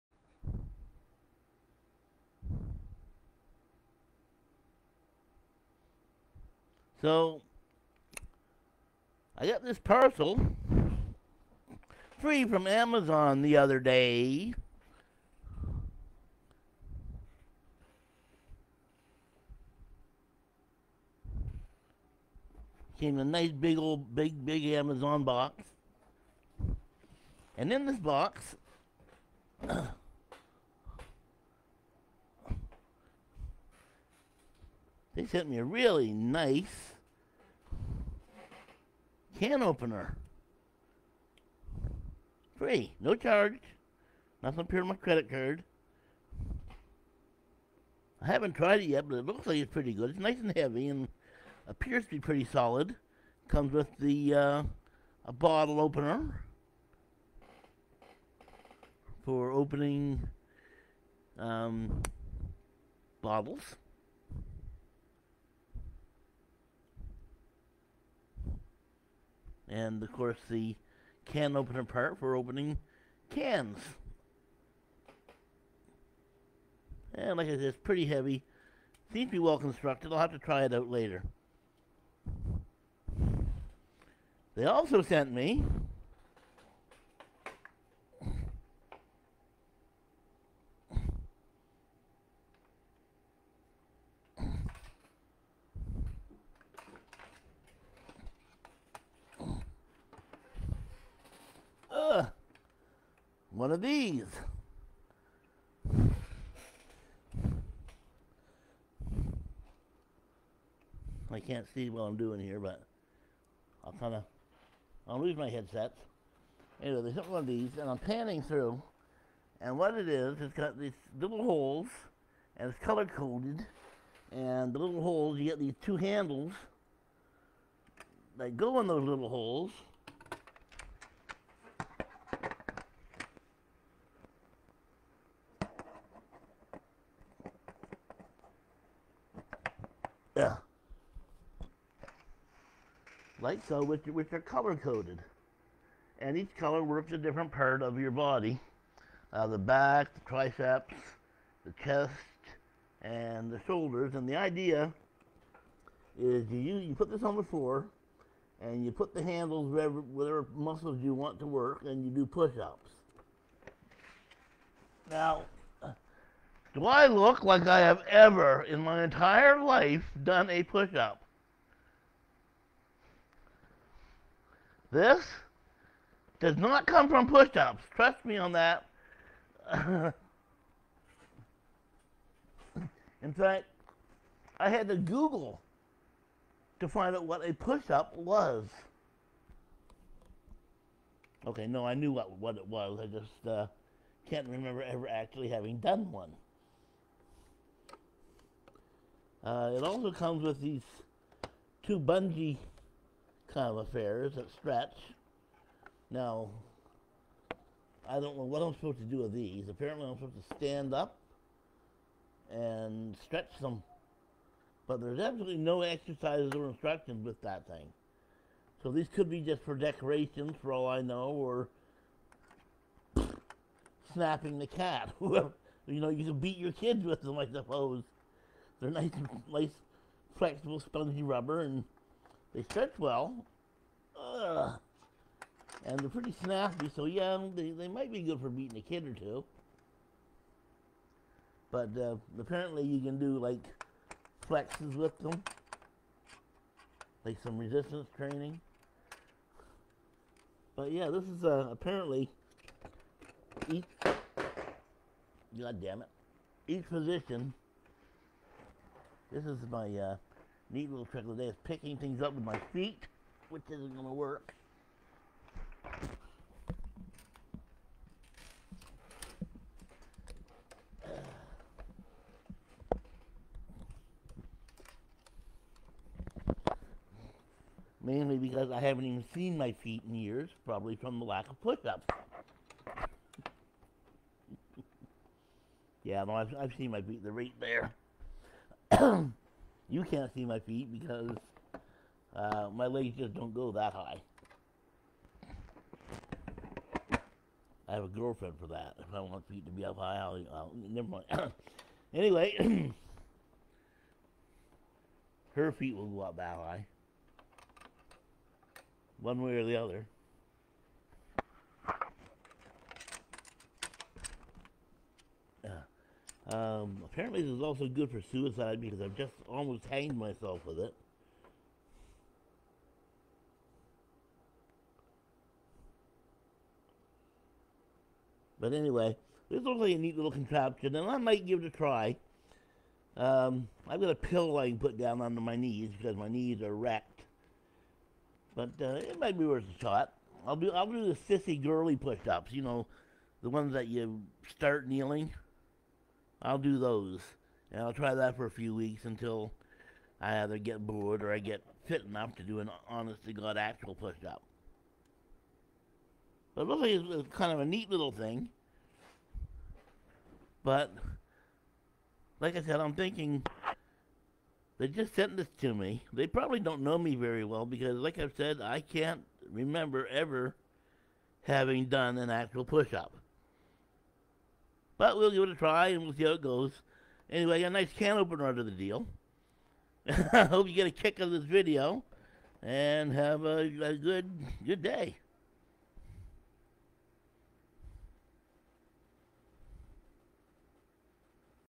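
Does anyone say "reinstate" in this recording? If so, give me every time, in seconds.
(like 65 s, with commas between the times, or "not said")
not said.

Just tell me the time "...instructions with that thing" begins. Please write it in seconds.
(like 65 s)
216 s.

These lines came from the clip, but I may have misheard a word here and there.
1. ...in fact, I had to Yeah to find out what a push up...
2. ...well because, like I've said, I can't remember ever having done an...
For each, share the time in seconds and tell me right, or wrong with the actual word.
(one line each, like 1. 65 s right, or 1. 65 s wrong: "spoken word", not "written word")
1. 179 s wrong: "Google", not "Yeah"
2. 367 s right.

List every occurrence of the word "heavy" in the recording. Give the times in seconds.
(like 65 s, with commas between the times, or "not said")
50 s, 78 s.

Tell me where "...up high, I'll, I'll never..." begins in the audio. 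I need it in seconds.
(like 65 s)
299 s.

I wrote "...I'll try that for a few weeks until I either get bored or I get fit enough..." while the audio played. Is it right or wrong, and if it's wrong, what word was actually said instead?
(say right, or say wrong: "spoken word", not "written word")
right.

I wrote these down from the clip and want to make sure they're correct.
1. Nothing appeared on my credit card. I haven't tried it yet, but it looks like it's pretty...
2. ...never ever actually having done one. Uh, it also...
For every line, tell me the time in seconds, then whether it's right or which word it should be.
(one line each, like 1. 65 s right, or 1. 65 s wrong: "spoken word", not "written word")
1. 44 s right
2. 194 s wrong: "remember", not "never".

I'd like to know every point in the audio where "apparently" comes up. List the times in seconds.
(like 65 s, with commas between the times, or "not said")
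209 s, 242 s, 251 s, 317 s.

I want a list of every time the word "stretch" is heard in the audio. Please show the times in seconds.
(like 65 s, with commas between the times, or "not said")
204 s, 213 s, 232 s.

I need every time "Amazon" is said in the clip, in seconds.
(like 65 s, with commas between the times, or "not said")
12 s, 24 s.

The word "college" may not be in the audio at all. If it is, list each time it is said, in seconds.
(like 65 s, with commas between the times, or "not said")
not said.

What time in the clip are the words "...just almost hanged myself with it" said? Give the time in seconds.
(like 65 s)
319 s.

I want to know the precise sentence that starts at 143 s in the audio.
Like so, which, which are color coded.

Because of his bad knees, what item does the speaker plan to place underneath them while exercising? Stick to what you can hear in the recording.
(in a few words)
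a pillow.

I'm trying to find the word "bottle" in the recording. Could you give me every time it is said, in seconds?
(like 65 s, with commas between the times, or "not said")
55 s, 63 s.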